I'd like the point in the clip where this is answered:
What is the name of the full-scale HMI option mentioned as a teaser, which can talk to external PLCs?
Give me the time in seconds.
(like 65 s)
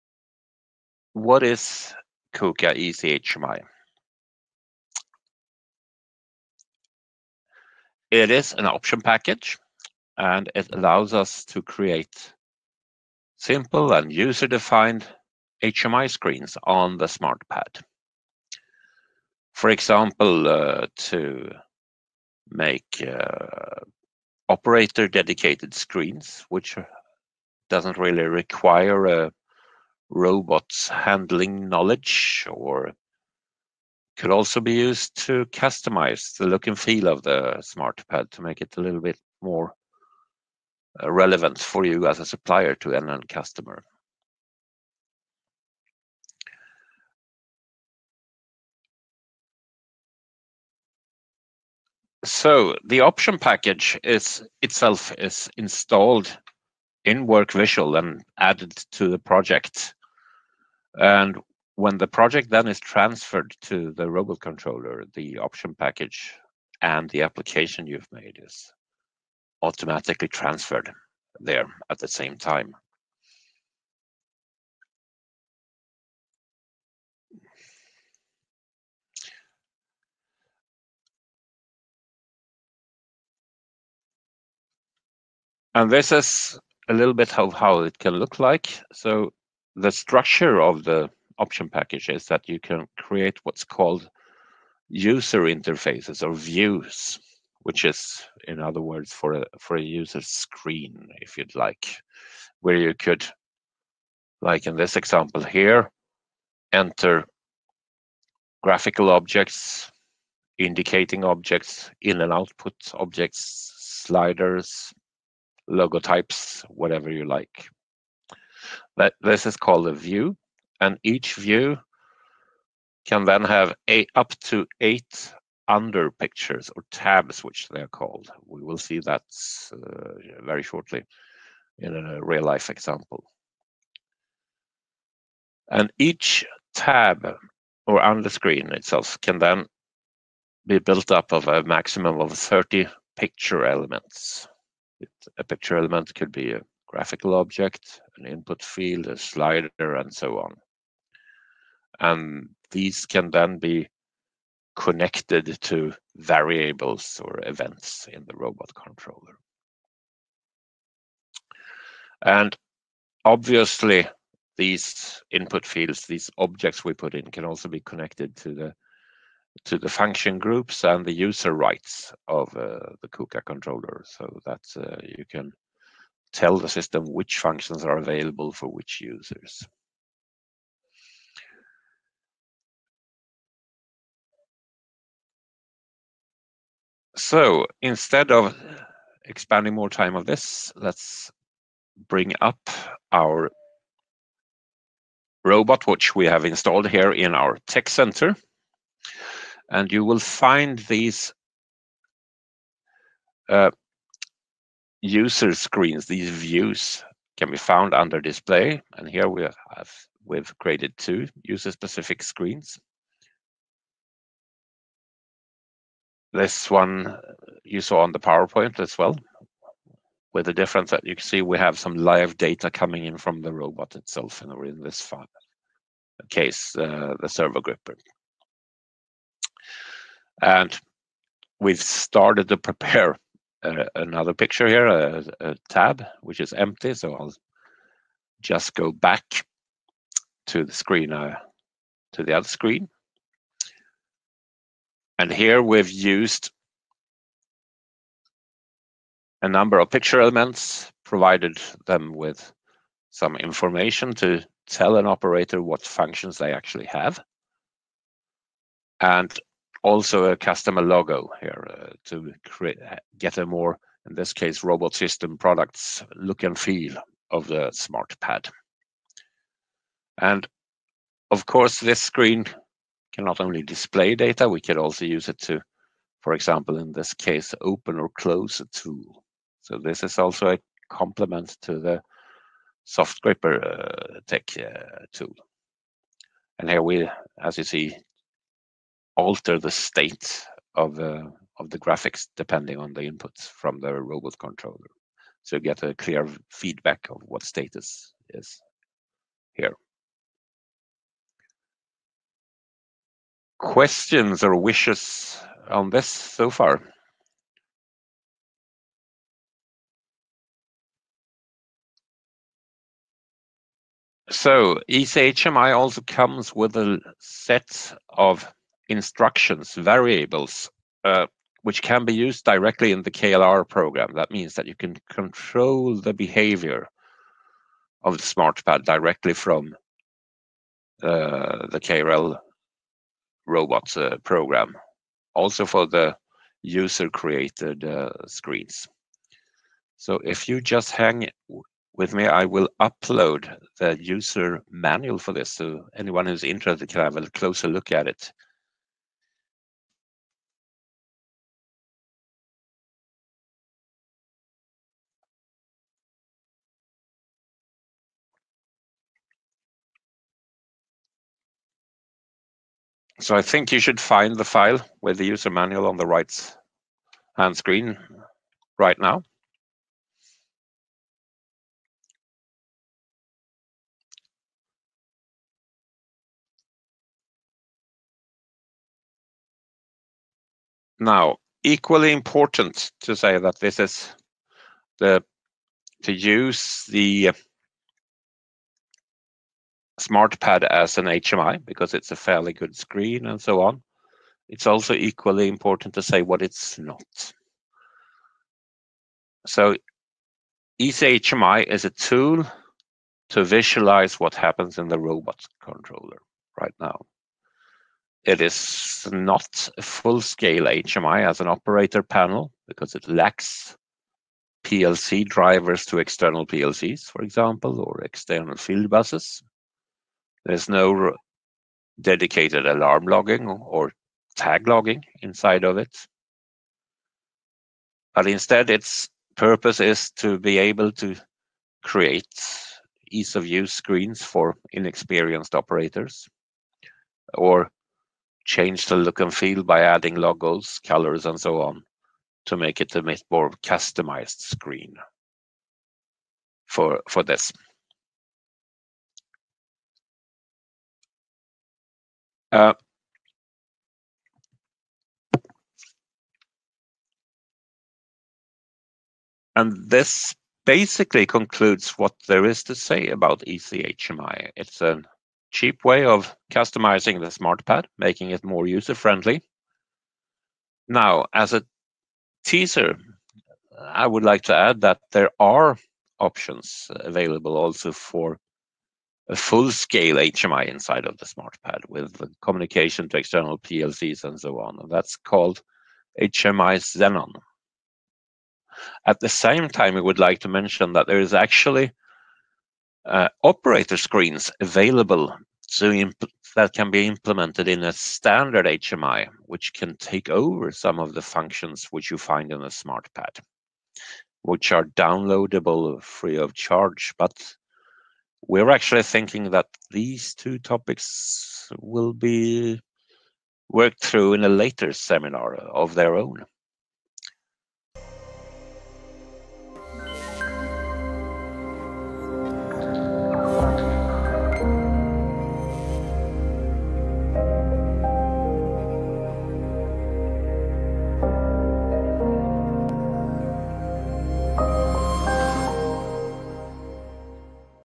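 486 s.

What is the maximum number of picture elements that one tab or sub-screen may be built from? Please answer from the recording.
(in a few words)
30.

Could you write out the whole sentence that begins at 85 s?
And this is a little bit of how it can look like.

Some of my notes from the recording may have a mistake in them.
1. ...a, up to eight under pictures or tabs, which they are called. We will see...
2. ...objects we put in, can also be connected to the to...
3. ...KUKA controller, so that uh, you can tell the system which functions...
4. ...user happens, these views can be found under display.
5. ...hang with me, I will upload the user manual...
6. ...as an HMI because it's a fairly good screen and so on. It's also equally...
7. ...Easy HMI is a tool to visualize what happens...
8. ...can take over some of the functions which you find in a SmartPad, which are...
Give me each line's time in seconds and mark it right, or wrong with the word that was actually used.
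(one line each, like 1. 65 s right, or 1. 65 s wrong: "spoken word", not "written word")
1. 123 s right
2. 166 s right
3. 173 s right
4. 205 s wrong: "screens", not "happens"
5. 340 s right
6. 390 s right
7. 400 s right
8. 499 s right.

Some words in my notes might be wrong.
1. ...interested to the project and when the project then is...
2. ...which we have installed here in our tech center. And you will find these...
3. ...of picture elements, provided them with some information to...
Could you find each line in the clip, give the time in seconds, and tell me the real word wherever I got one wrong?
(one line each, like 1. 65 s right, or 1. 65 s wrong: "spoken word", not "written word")
1. 58 s wrong: "added", not "interested"
2. 195 s right
3. 249 s right.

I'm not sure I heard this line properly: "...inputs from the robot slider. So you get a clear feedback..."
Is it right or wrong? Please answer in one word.
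wrong.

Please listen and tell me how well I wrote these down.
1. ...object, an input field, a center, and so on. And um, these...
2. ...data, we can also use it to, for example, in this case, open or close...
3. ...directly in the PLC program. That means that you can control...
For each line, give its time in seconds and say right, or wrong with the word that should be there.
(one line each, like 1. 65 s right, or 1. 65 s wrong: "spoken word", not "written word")
1. 147 s wrong: "slider", not "center"
2. 274 s right
3. 322 s wrong: "KLR", not "PLC".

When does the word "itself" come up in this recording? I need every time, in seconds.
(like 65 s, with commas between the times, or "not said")
54 s, 138 s, 223 s.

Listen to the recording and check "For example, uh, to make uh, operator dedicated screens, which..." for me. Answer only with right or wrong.
right.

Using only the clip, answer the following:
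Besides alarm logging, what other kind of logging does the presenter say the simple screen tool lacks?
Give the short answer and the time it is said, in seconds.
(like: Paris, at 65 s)
Tag logging, at 424 s.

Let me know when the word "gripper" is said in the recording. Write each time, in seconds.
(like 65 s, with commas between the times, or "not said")
227 s, 283 s.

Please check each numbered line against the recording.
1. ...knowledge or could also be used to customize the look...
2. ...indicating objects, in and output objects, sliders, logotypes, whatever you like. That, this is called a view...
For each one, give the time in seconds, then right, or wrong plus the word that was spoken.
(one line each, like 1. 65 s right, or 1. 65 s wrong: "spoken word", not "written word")
1. 31 s right
2. 110 s right.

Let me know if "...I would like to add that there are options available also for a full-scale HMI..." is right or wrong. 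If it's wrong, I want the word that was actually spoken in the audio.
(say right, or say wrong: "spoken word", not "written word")
right.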